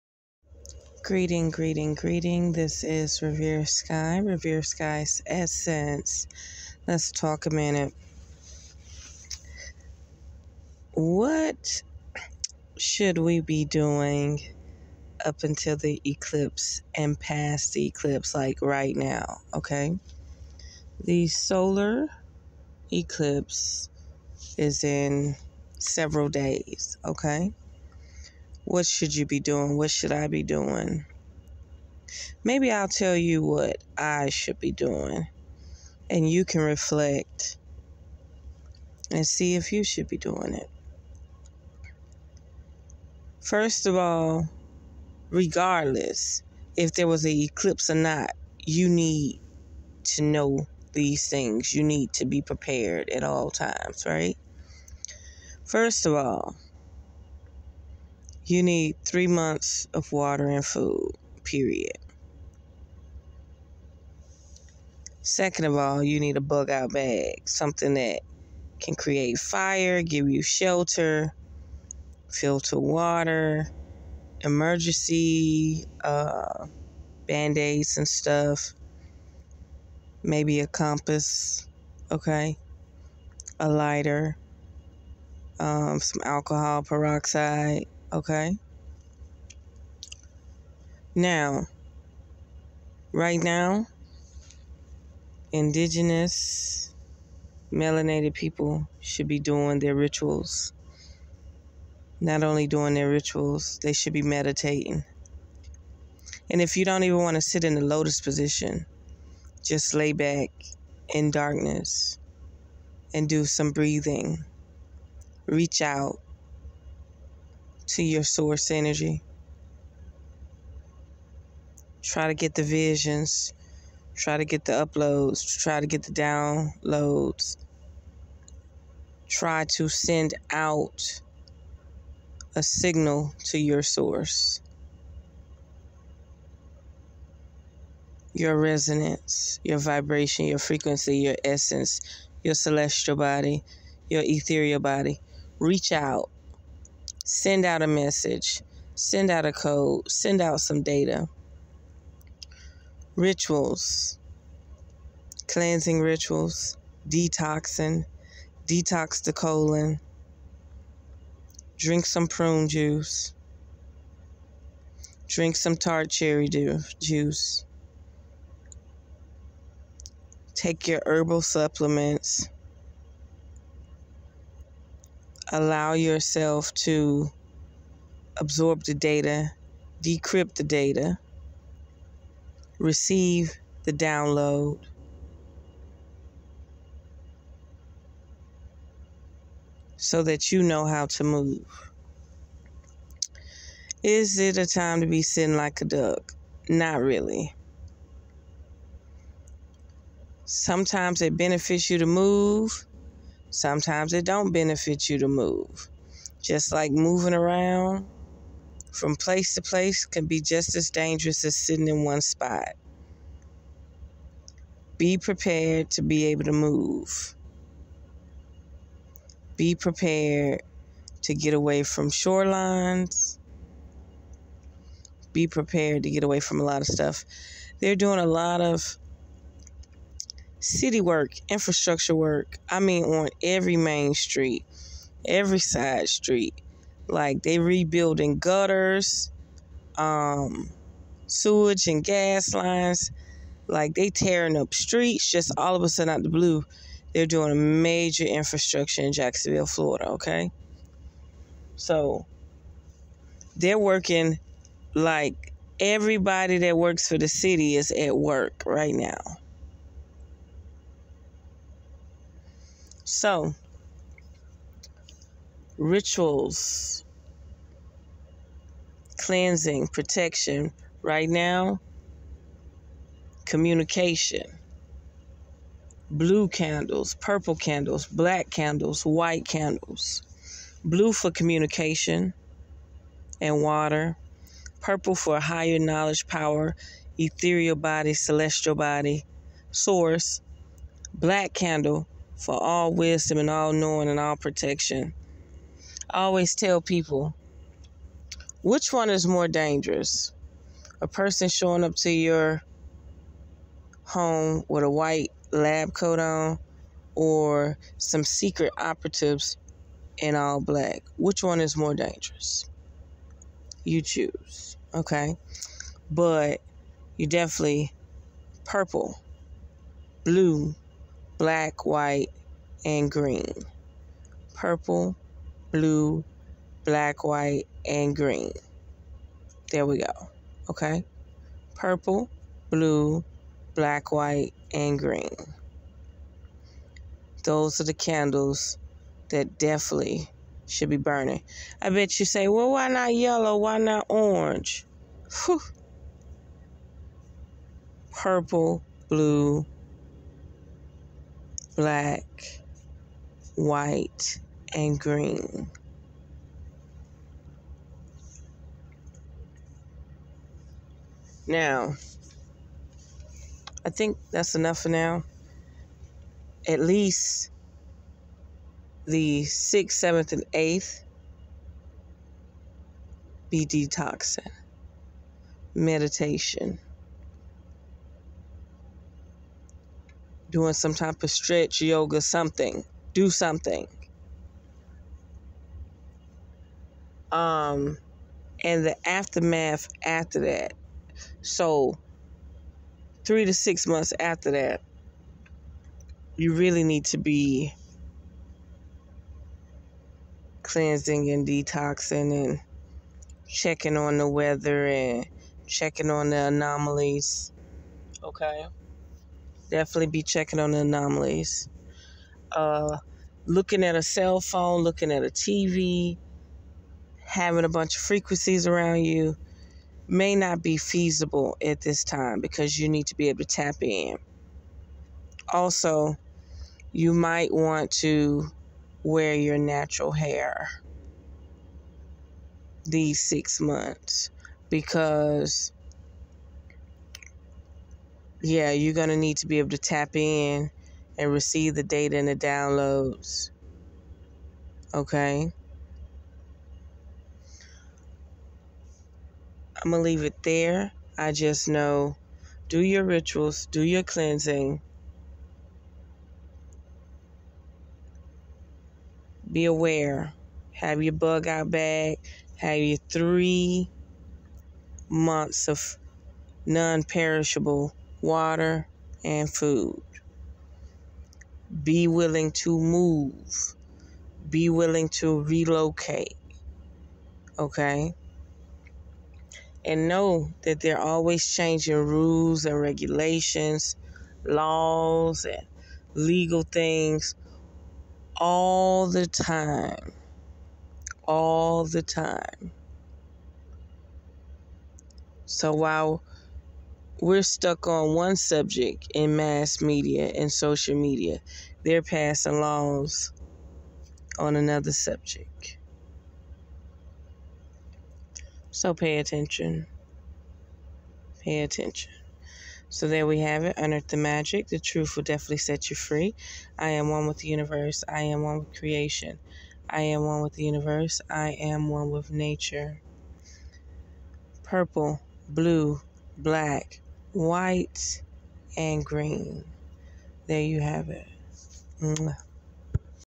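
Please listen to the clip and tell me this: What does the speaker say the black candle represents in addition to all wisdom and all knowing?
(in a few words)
All protection.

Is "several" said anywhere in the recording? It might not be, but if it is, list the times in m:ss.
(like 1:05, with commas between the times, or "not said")
0:25.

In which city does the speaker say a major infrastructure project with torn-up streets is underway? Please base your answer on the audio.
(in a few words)
Jacksonville, Florida.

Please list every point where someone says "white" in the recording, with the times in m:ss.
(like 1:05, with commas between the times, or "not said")
4:39, 5:04, 5:21, 5:27, 5:34, 5:53, 8:47.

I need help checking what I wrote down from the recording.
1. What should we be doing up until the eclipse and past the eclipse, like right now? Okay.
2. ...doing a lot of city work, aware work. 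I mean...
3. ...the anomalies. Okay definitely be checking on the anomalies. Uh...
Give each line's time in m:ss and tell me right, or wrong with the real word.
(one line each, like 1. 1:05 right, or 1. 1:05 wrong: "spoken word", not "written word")
1. 0:10 right
2. 3:47 wrong: "infrastructure", not "aware"
3. 6:46 right.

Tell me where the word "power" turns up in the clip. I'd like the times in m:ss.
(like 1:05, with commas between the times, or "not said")
4:46.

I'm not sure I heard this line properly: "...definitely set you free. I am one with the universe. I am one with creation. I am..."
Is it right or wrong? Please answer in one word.
right.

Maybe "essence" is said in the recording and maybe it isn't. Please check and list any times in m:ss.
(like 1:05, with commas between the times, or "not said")
0:05, 2:21.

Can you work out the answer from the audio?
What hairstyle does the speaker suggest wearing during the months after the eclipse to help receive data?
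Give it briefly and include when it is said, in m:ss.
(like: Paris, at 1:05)
Natural hair, at 7:09.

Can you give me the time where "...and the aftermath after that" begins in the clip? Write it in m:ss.
6:28.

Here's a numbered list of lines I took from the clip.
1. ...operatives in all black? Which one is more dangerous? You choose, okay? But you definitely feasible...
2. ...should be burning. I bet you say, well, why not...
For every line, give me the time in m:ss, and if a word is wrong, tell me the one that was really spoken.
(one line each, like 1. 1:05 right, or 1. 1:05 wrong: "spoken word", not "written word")
1. 5:08 wrong: "purple", not "feasible"
2. 5:40 right.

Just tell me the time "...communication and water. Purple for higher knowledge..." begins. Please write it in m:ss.
4:41.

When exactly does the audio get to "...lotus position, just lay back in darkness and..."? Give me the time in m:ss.
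1:47.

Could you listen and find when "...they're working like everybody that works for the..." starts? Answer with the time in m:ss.
4:13.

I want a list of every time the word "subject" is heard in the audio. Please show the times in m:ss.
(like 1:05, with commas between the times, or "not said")
8:18, 8:24.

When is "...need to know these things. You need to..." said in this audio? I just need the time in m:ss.
0:48.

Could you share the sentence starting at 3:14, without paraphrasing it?
Is it a time to be sitting like a duck?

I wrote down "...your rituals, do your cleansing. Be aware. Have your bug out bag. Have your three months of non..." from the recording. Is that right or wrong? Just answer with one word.
right.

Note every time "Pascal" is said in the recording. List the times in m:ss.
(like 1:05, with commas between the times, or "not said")
not said.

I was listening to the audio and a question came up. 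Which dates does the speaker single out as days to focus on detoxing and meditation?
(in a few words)
6th, 7th, and 8th.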